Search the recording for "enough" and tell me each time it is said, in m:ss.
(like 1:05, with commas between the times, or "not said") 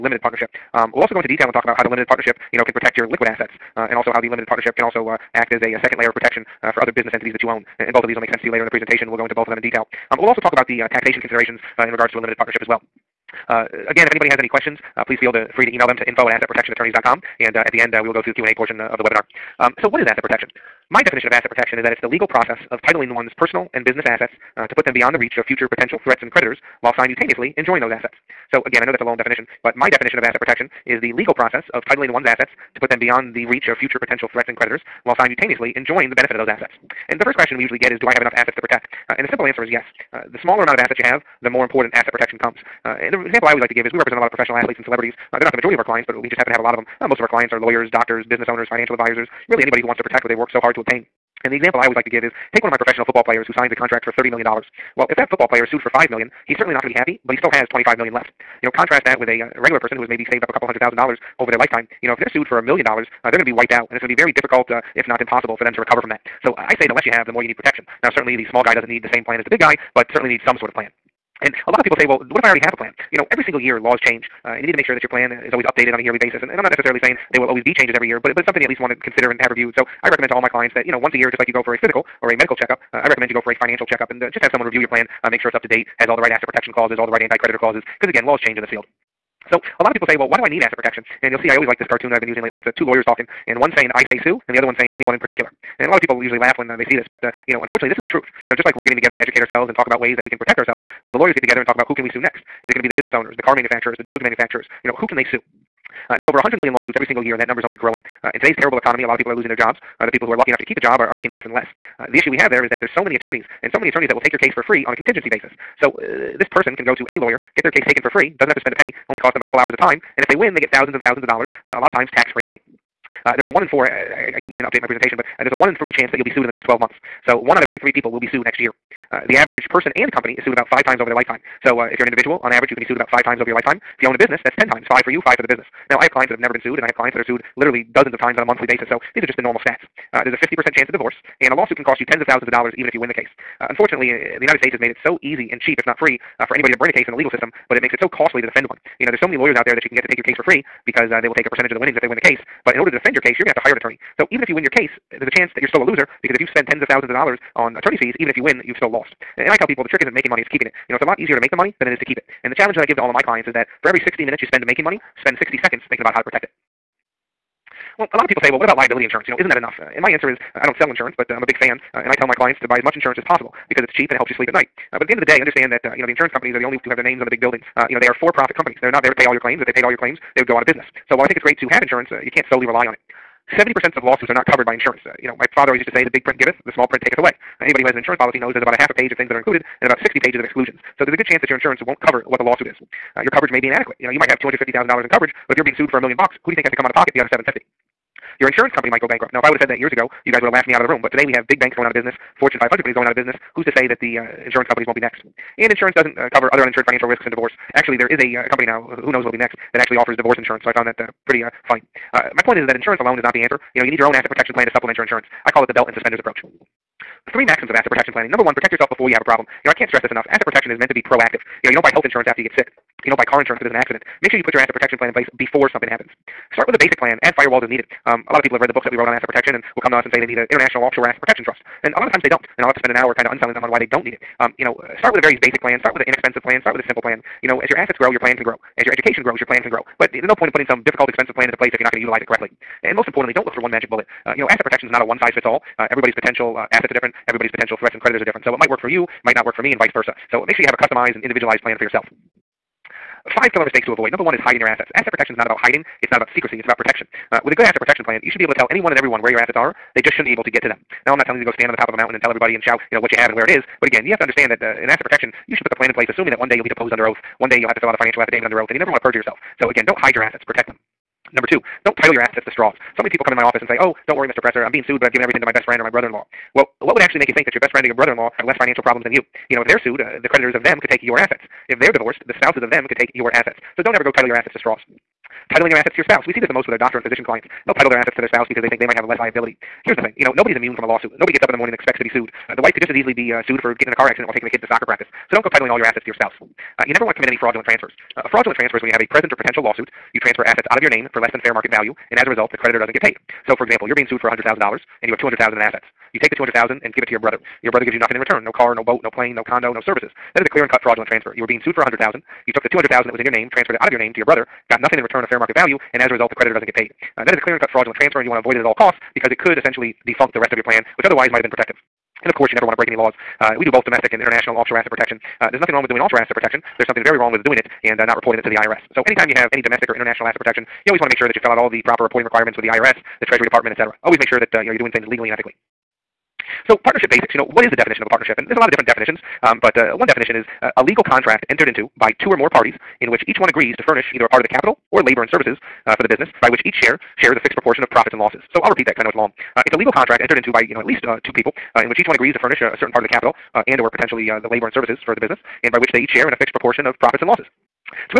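0:38, 1:50, 2:49, 3:40.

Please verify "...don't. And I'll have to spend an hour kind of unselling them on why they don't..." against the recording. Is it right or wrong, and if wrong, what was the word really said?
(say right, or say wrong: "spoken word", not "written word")
right.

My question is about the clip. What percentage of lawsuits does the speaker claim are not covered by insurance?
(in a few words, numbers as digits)
70%.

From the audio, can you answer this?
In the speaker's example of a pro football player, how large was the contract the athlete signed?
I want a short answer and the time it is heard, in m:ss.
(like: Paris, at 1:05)
$30 million, at 0:54.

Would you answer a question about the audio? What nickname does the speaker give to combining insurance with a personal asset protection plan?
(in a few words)
belt and suspenders approach.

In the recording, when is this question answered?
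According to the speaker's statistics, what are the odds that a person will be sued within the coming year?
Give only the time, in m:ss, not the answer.
2:05.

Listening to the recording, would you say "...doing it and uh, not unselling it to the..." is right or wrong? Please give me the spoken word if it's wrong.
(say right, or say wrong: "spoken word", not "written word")
wrong: "reporting", not "unselling".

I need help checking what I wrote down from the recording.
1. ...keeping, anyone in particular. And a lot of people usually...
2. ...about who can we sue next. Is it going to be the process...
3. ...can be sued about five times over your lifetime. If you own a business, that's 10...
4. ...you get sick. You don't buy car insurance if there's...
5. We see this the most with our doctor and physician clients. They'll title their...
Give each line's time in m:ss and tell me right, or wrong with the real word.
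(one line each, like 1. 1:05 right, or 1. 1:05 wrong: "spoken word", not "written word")
1. 1:34 wrong: "saying", not "keeping"
2. 1:41 wrong: "business", not "process"
3. 2:12 right
4. 3:42 right
5. 4:46 right.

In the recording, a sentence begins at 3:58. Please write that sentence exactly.
As your education grows, your plan can grow.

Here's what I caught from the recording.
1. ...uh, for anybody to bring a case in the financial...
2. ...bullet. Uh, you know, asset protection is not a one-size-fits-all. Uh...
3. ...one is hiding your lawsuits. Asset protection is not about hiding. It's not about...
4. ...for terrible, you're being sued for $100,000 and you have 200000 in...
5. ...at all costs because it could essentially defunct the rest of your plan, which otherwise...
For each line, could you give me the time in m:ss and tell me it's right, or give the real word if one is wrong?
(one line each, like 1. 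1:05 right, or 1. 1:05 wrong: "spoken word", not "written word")
1. 2:26 wrong: "legal", not "financial"
2. 4:03 right
3. 4:14 wrong: "assets", not "lawsuits"
4. 5:03 wrong: "example", not "terrible"
5. 5:18 right.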